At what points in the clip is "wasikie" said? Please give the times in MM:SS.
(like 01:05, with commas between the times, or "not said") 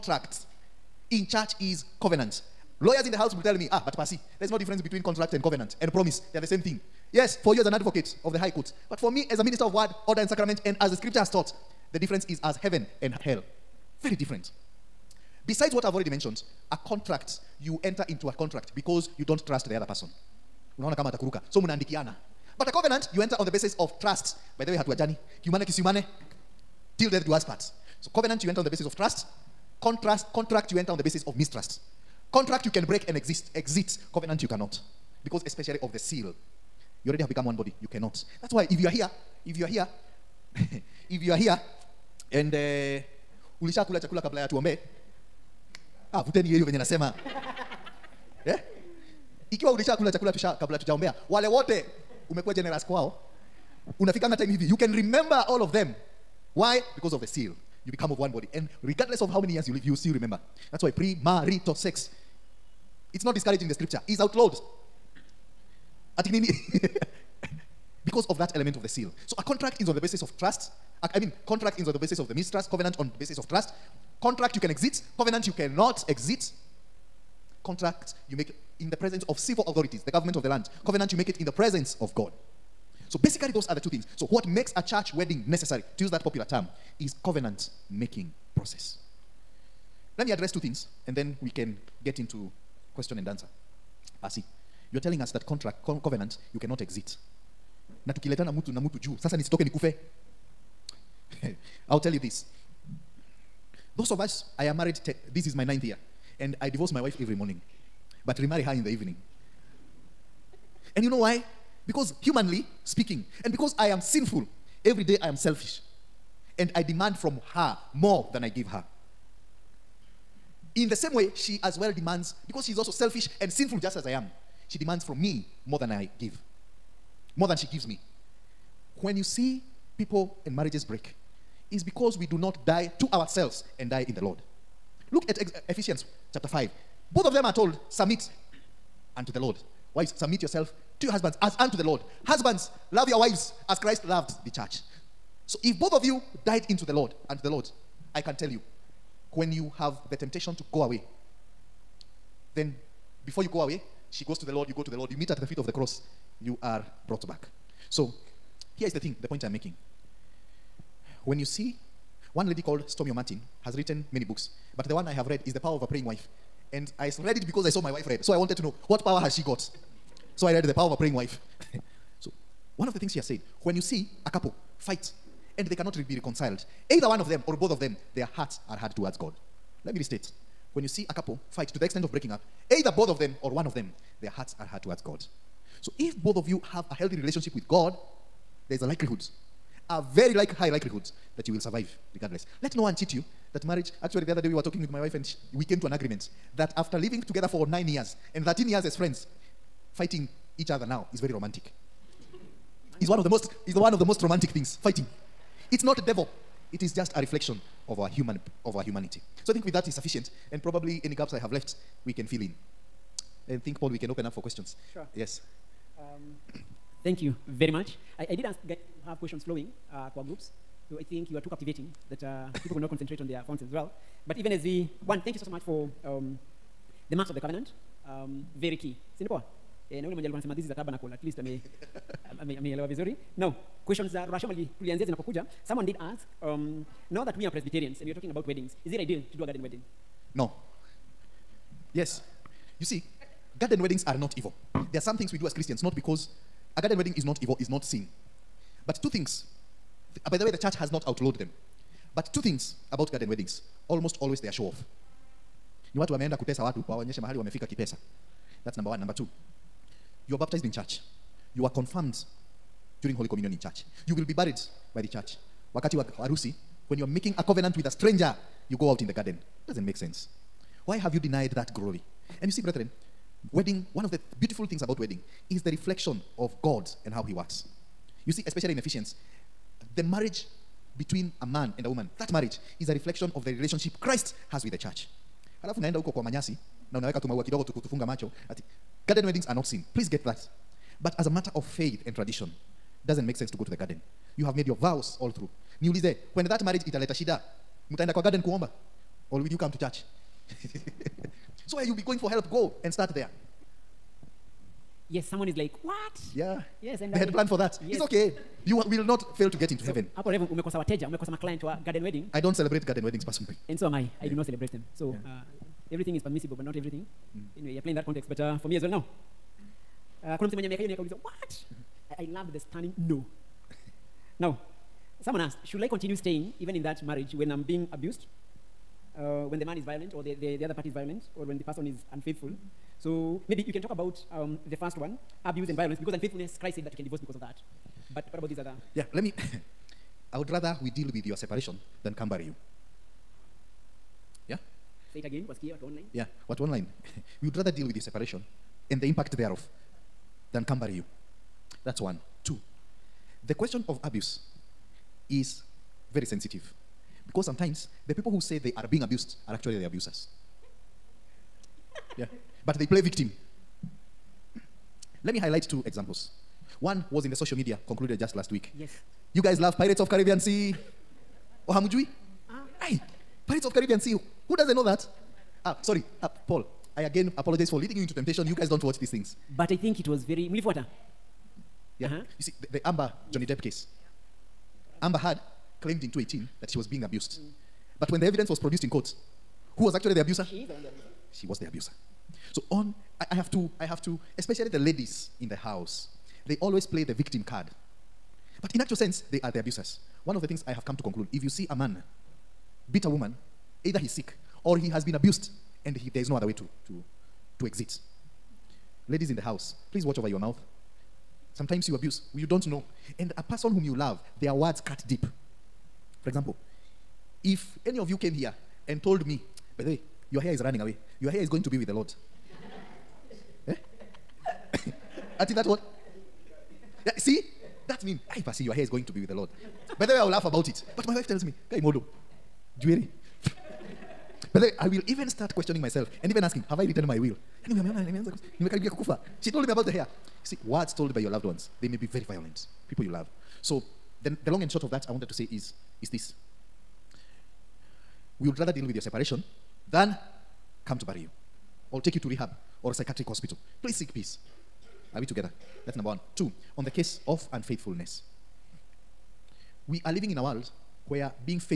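05:45.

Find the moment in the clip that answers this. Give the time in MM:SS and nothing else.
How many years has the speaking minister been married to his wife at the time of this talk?
01:45.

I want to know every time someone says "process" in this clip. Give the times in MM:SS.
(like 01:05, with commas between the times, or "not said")
01:28.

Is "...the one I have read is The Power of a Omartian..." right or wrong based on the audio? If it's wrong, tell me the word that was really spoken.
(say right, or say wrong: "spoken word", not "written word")
wrong: "Praying", not "Omartian".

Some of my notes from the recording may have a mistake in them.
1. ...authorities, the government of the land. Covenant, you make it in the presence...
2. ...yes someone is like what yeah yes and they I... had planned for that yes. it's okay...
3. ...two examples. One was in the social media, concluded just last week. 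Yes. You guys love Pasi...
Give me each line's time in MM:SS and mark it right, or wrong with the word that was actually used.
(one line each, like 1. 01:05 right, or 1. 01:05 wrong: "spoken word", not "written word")
1. 01:19 right
2. 05:05 right
3. 06:05 wrong: "Pirates", not "Pasi".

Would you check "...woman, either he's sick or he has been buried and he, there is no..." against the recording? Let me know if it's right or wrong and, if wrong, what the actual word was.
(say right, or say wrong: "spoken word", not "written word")
wrong: "abused", not "buried".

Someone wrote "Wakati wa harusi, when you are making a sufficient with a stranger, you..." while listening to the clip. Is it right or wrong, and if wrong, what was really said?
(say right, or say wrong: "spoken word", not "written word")
wrong: "covenant", not "sufficient".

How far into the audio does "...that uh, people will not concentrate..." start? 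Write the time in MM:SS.
03:42.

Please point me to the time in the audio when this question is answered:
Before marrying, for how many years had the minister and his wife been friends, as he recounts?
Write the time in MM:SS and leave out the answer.
03:18.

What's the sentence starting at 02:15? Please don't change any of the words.
Look at ex- Ephesians chapter 5.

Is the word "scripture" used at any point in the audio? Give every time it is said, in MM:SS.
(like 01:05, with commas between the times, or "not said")
00:10, 01:03.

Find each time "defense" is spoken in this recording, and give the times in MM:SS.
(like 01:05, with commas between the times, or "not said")
not said.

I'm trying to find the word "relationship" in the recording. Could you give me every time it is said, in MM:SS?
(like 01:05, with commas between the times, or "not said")
03:07, 04:43.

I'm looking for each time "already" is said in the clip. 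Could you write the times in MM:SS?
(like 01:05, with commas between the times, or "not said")
00:15, 00:37.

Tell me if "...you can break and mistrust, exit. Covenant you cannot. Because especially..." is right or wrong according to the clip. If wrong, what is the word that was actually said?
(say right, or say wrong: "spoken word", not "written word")
wrong: "exist", not "mistrust".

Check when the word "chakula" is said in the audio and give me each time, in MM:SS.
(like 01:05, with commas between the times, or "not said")
00:43, 00:50.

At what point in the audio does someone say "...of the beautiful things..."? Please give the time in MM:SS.
04:34.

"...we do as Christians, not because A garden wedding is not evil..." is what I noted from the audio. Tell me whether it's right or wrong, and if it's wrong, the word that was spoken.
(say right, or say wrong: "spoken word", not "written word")
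right.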